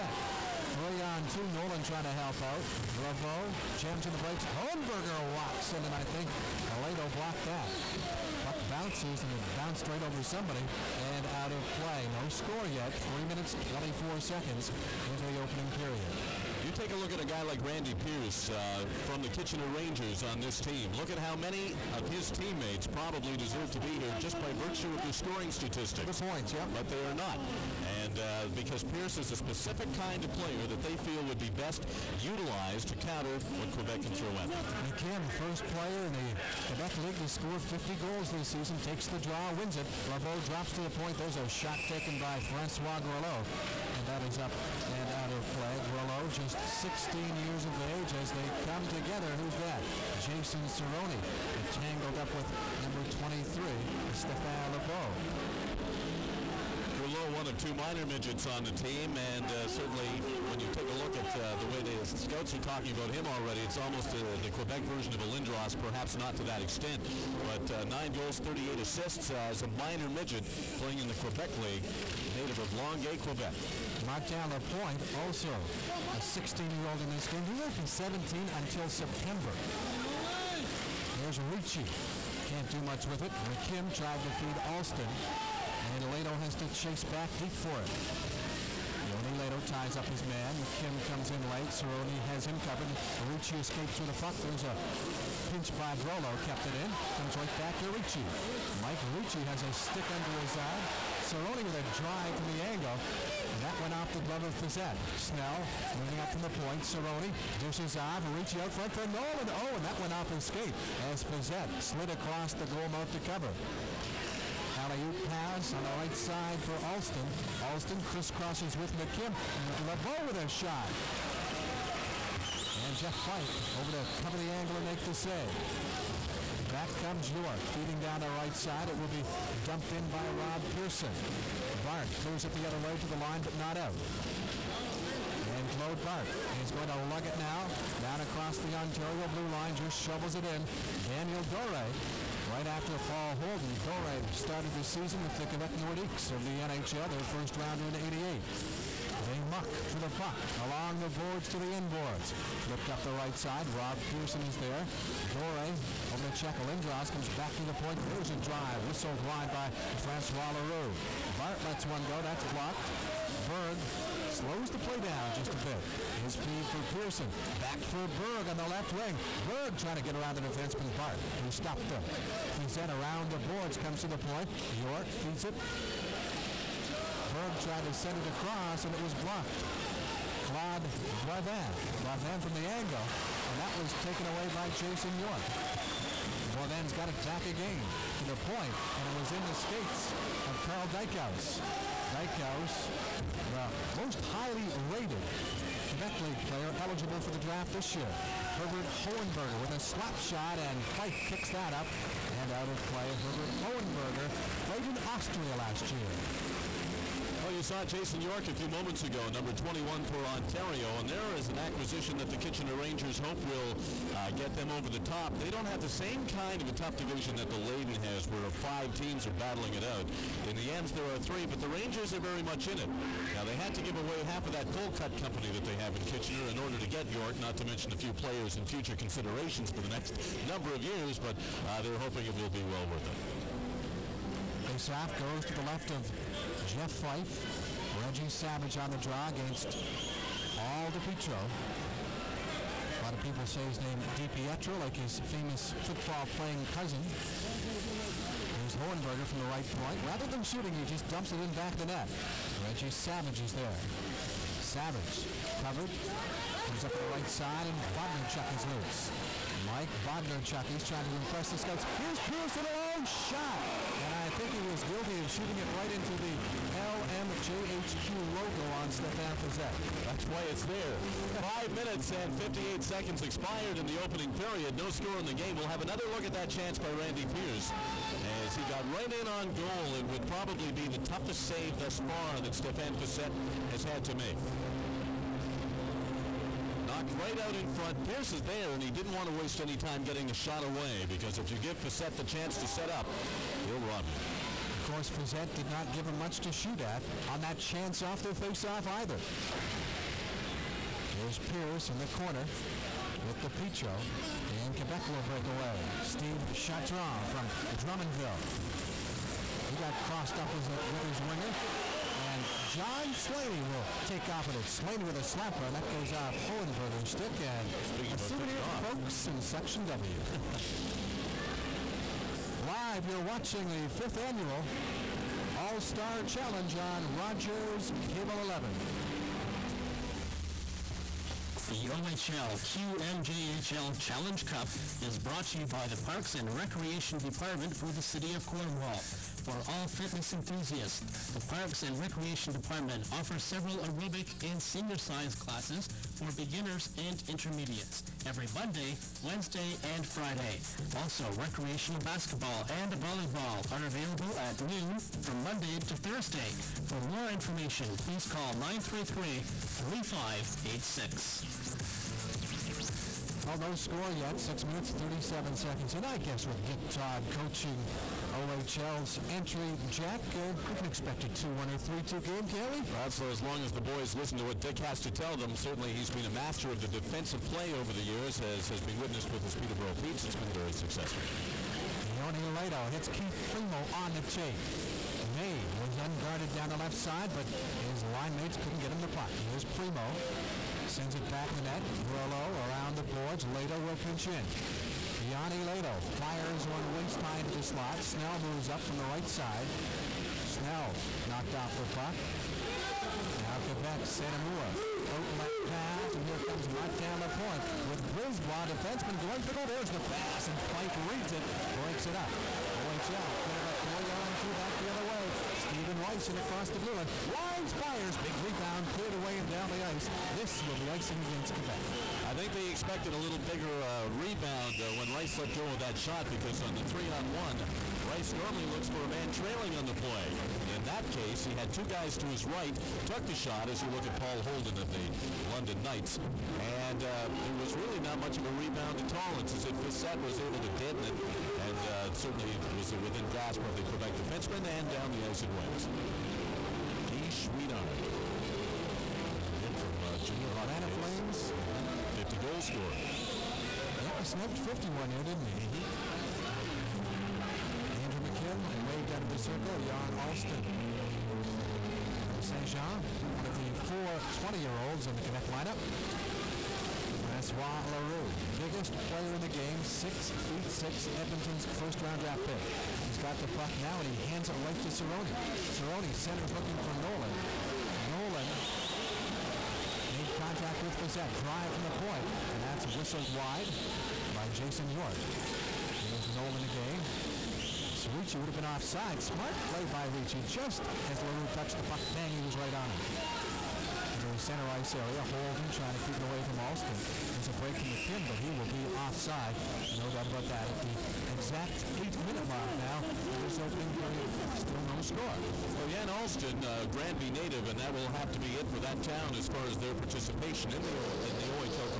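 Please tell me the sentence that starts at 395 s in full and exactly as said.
Joni Lehto fires one waist high into the slot.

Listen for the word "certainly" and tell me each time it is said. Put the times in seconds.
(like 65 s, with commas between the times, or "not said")
59 s, 375 s, 442 s.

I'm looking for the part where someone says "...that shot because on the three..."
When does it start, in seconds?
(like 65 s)
425 s.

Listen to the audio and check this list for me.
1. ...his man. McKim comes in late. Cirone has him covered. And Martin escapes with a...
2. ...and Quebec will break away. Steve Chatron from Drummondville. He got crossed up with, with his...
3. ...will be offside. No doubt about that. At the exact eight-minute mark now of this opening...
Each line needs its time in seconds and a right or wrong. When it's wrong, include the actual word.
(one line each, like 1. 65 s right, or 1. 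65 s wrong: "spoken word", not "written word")
1. 90 s wrong: "Ricci", not "Martin"
2. 304 s right
3. 498 s right.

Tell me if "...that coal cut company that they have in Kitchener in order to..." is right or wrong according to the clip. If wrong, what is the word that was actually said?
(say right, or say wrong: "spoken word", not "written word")
right.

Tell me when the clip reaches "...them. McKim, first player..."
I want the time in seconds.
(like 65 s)
34 s.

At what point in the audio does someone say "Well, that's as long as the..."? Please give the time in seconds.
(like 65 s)
372 s.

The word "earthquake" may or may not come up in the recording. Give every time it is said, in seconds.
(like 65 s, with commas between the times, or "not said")
not said.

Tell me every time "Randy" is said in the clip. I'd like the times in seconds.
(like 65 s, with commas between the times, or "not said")
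17 s, 276 s.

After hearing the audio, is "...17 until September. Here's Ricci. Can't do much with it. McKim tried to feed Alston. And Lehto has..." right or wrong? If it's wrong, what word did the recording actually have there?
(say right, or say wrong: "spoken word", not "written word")
right.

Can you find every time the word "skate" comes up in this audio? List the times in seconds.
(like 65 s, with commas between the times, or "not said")
110 s, 189 s.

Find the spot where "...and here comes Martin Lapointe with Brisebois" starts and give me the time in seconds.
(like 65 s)
406 s.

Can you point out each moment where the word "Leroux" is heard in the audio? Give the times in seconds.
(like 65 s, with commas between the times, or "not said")
160 s, 467 s, 491 s.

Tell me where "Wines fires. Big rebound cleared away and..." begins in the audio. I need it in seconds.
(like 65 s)
417 s.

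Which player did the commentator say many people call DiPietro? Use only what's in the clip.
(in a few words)
Paul Pietro.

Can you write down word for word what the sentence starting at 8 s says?
Buck bounces, and it bounced straight over somebody and out of play.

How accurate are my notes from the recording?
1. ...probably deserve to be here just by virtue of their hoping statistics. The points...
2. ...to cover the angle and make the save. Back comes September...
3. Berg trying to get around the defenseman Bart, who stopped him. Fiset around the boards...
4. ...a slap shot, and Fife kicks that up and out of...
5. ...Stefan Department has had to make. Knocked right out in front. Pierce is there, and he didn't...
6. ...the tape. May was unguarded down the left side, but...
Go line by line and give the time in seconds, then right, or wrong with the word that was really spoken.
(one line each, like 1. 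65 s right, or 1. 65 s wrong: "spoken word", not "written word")
1. 22 s wrong: "scoring", not "hoping"
2. 123 s wrong: "York", not "September"
3. 169 s right
4. 199 s right
5. 282 s wrong: "Fiset", not "Department"
6. 384 s right.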